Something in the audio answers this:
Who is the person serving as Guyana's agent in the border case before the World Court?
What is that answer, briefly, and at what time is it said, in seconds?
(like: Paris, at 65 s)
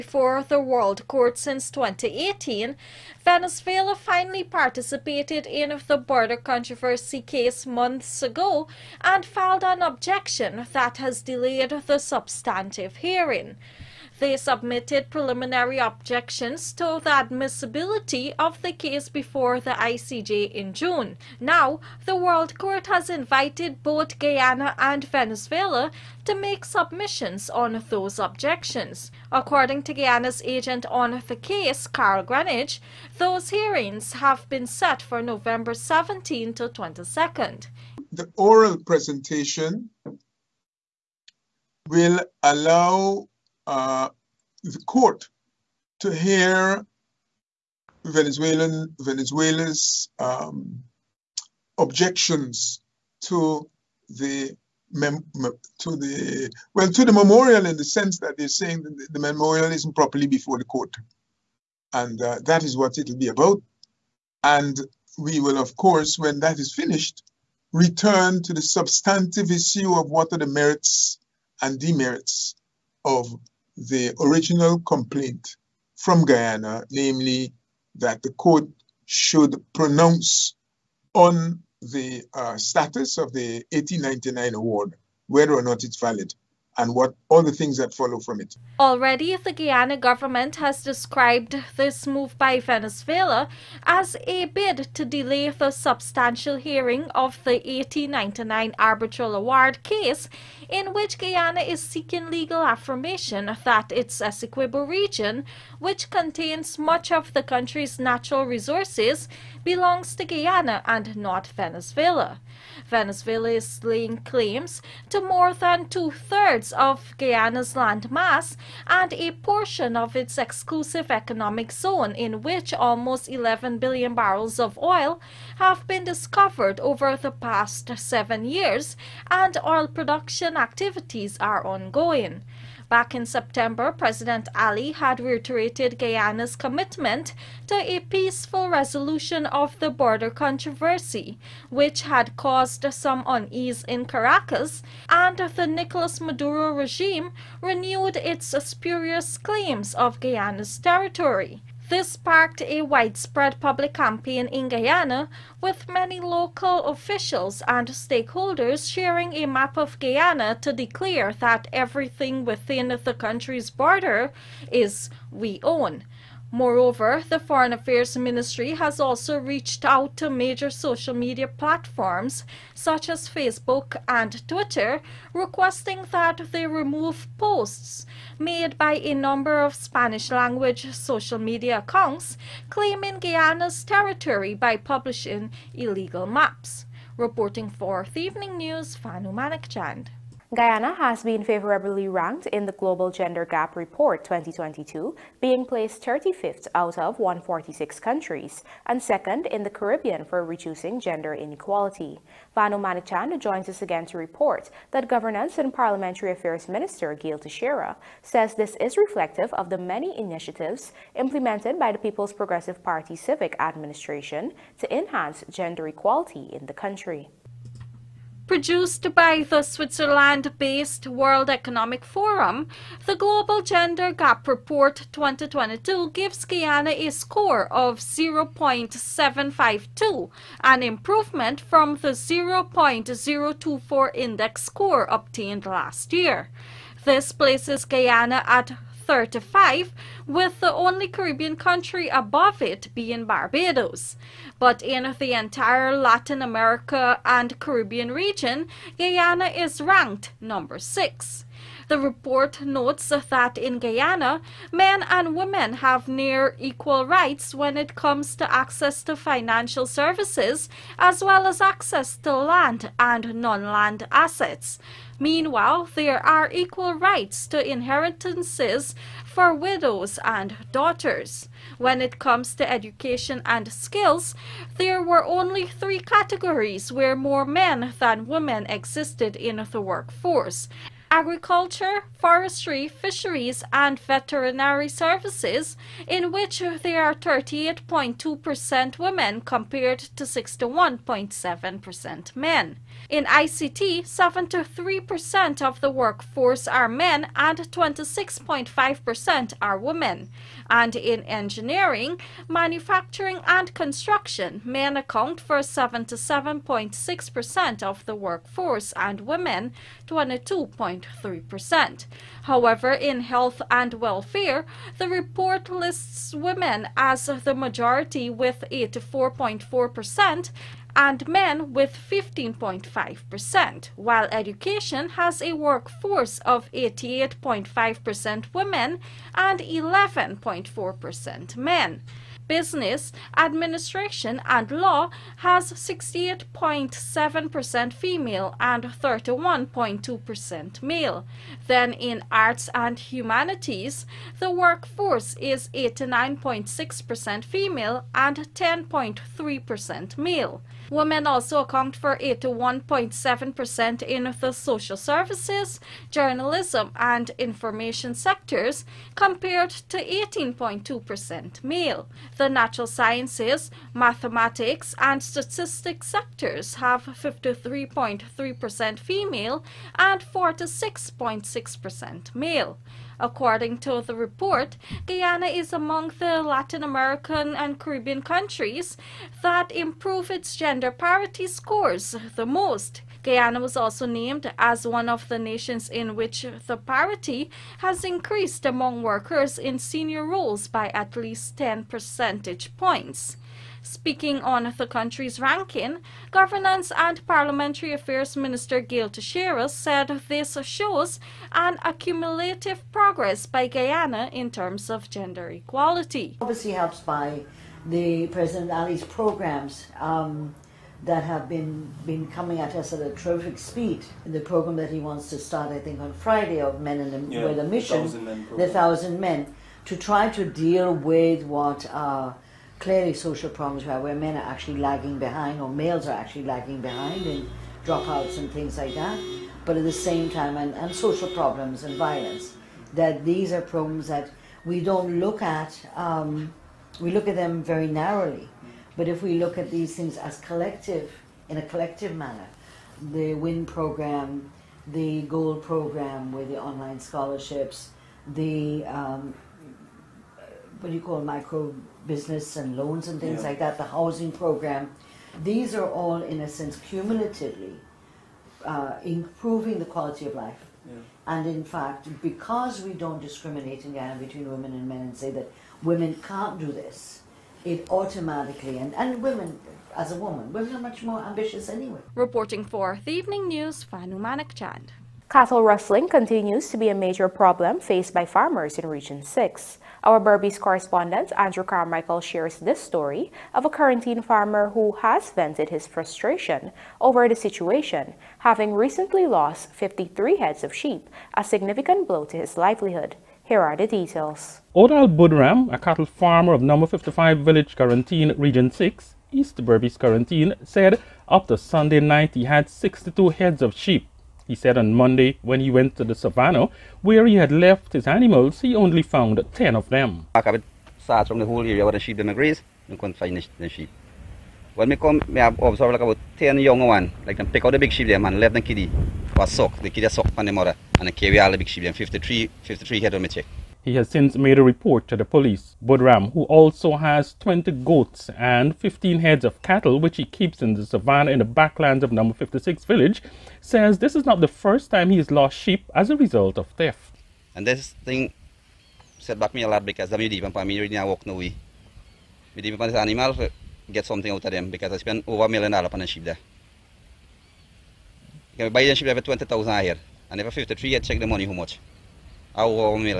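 Carl Greenwich, at 31 s.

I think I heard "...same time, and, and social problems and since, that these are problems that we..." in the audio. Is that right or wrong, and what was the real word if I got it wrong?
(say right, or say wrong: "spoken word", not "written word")
wrong: "violence", not "since".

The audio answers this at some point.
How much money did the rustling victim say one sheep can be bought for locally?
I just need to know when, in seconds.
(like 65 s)
549 s.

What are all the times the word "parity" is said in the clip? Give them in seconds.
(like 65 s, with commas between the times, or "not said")
380 s, 386 s.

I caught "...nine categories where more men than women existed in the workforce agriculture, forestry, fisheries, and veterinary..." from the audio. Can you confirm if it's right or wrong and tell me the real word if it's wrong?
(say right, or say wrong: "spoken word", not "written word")
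wrong: "three", not "nine".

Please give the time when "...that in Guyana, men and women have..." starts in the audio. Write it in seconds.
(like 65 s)
253 s.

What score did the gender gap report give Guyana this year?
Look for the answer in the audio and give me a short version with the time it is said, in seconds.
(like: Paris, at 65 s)
0.752, at 227 s.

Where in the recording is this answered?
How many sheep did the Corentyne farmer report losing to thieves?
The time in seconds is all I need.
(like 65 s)
489 s.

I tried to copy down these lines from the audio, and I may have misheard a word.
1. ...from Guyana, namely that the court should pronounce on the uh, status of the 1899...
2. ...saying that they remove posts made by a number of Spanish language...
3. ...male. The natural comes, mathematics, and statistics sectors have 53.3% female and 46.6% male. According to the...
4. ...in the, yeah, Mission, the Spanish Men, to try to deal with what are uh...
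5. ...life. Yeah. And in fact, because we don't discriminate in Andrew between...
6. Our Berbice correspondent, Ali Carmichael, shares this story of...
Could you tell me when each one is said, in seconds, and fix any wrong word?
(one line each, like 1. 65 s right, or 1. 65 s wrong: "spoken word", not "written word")
1. 75 s right
2. 175 s wrong: "requesting", not "saying"
3. 361 s wrong: "sciences", not "comes"
4. 416 s wrong: "Thousand", not "Spanish"
5. 460 s wrong: "Guyana", not "Andrew"
6. 480 s wrong: "Andrew", not "Ali".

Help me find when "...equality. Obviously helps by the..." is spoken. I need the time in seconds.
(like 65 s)
405 s.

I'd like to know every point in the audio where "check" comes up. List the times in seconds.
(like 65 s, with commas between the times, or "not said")
523 s, 550 s.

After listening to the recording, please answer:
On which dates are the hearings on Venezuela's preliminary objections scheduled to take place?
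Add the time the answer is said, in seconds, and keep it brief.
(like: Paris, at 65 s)
November 17 to 22, at 35 s.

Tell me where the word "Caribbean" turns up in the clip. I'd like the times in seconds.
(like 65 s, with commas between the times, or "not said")
199 s, 241 s, 247 s, 377 s.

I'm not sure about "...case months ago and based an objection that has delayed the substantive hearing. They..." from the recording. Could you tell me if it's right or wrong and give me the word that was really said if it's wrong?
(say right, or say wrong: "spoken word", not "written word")
wrong: "filed", not "based".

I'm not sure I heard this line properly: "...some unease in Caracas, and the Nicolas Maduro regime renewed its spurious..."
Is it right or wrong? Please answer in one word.
right.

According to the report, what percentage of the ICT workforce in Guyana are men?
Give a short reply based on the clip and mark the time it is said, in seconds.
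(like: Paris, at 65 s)
73%, at 294 s.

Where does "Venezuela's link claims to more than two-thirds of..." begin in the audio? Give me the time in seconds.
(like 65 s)
112 s.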